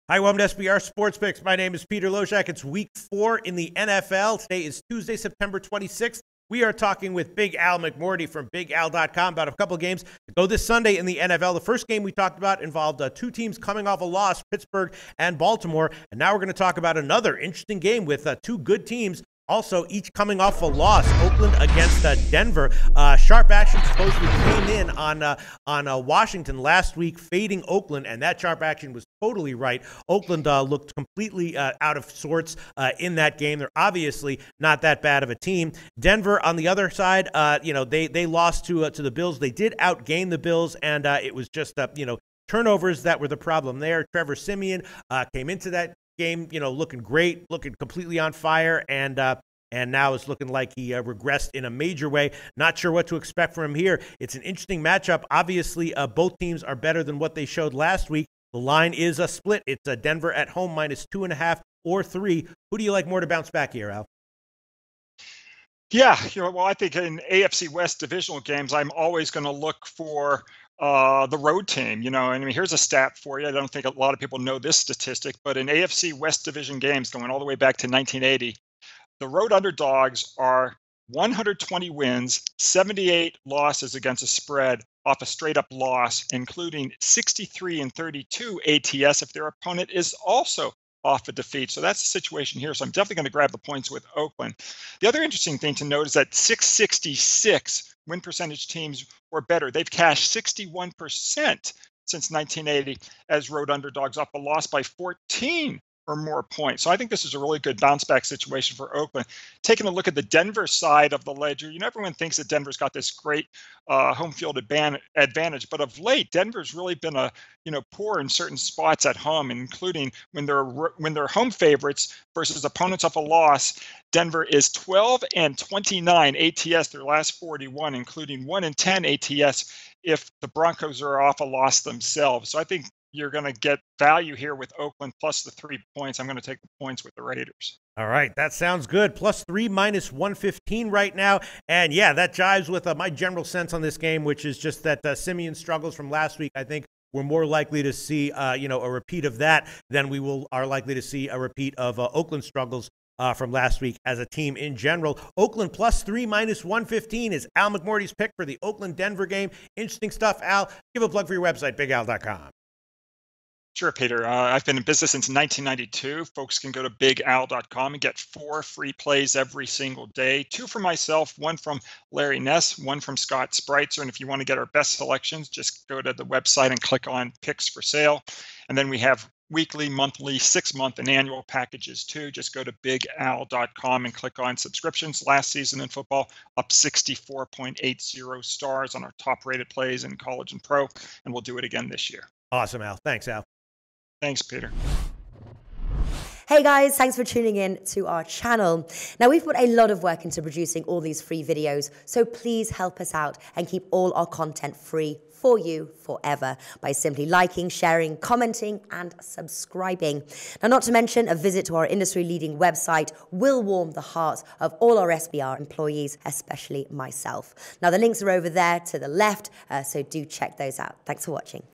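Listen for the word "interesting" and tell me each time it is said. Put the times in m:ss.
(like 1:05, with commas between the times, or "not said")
0:17, 0:54, 1:35, 2:39.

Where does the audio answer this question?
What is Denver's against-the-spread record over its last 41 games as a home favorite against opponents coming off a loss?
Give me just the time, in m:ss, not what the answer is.
2:04.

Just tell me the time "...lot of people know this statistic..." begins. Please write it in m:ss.
1:13.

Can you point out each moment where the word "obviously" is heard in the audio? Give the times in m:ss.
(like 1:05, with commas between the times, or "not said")
0:33, 0:55.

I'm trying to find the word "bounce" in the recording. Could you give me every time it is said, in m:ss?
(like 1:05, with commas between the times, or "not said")
1:03, 1:47.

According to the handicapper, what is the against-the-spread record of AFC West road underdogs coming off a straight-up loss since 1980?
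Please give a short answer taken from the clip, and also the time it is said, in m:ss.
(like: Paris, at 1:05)
120-78, at 1:21.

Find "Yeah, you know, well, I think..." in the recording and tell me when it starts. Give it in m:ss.
1:05.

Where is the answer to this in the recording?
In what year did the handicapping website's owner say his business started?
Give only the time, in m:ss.
2:45.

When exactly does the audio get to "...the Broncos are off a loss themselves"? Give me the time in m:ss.
2:10.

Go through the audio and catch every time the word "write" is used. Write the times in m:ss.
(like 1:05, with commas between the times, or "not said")
not said.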